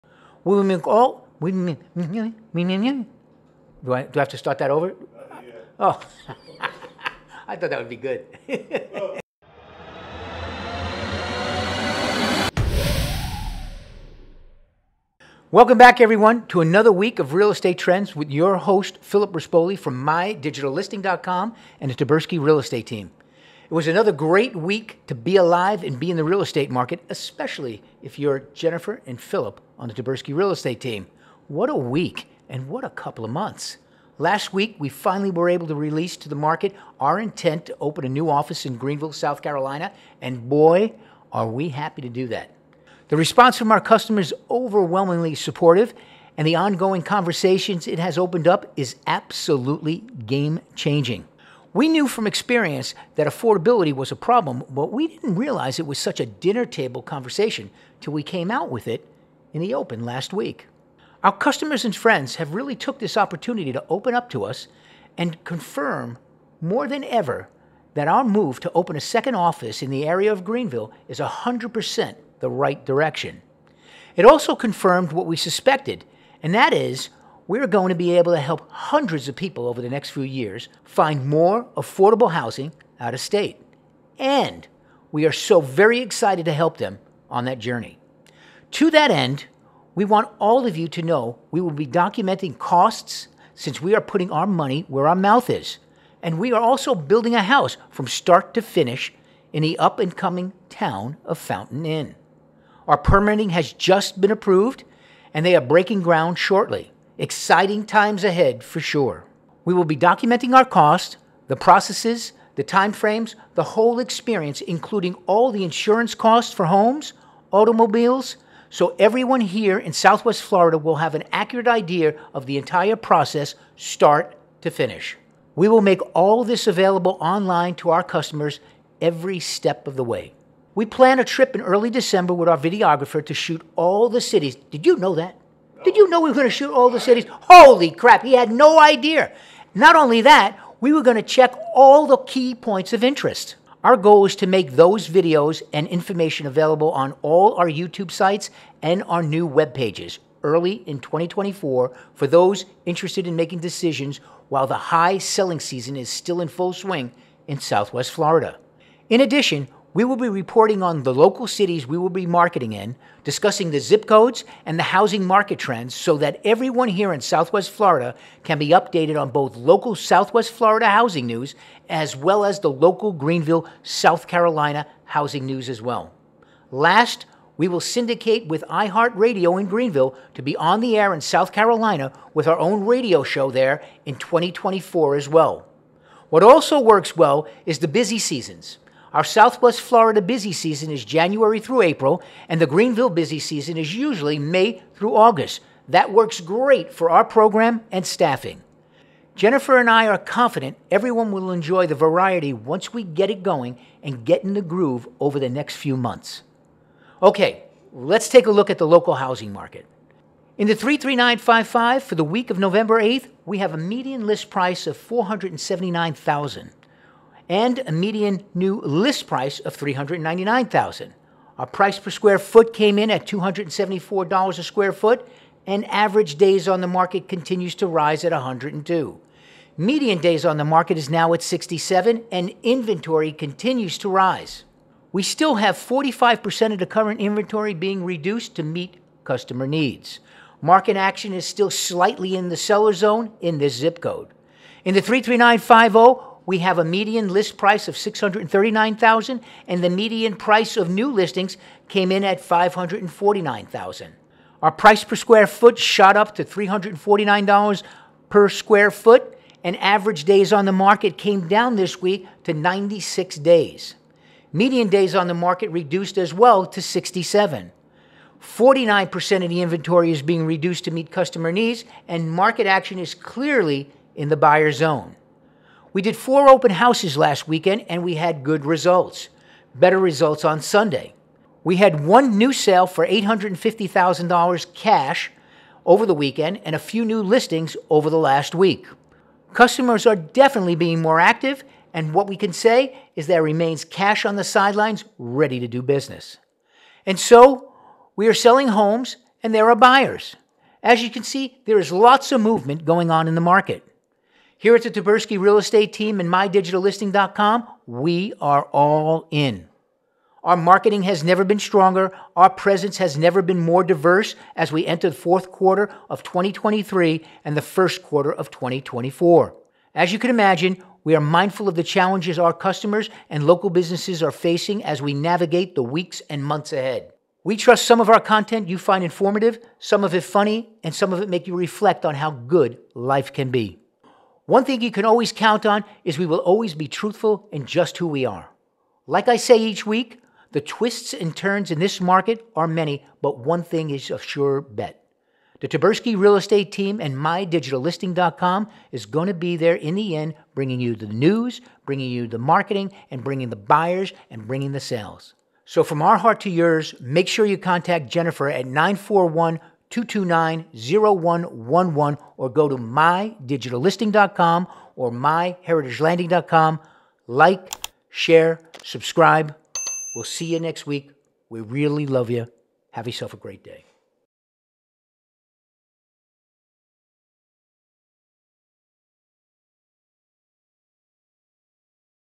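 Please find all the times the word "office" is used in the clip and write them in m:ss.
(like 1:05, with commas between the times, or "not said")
0:38, 1:09.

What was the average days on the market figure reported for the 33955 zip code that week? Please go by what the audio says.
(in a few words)
102.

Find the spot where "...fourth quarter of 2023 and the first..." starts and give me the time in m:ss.
5:15.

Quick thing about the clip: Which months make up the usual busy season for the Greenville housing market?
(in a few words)
May through August.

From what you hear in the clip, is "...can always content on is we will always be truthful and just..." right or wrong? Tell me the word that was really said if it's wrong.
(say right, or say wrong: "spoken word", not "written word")
wrong: "count", not "content".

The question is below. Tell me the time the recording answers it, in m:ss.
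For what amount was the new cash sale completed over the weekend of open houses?
4:43.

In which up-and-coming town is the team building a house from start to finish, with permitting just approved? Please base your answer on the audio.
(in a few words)
Fountain Inn.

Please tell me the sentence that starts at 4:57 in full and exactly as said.
And so, we are selling homes and there are buyers.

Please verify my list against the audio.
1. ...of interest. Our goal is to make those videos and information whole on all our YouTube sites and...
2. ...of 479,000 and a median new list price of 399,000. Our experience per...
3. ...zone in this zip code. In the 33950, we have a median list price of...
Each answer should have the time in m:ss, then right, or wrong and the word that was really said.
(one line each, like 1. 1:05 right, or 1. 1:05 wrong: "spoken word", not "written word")
1. 2:22 wrong: "available", not "whole"
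2. 3:34 wrong: "price", not "experience"
3. 4:02 right.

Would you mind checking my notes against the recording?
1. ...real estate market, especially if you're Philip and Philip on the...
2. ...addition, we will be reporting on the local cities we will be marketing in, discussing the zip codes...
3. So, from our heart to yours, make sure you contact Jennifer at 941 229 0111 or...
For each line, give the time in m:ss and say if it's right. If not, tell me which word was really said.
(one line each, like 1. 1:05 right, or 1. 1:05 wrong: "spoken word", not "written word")
1. 0:26 wrong: "Jennifer", not "Philip"
2. 2:39 right
3. 5:55 right.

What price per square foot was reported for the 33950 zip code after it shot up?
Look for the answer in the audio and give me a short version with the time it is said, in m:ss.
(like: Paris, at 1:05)
$349, at 4:16.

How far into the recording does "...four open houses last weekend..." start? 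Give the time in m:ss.
4:36.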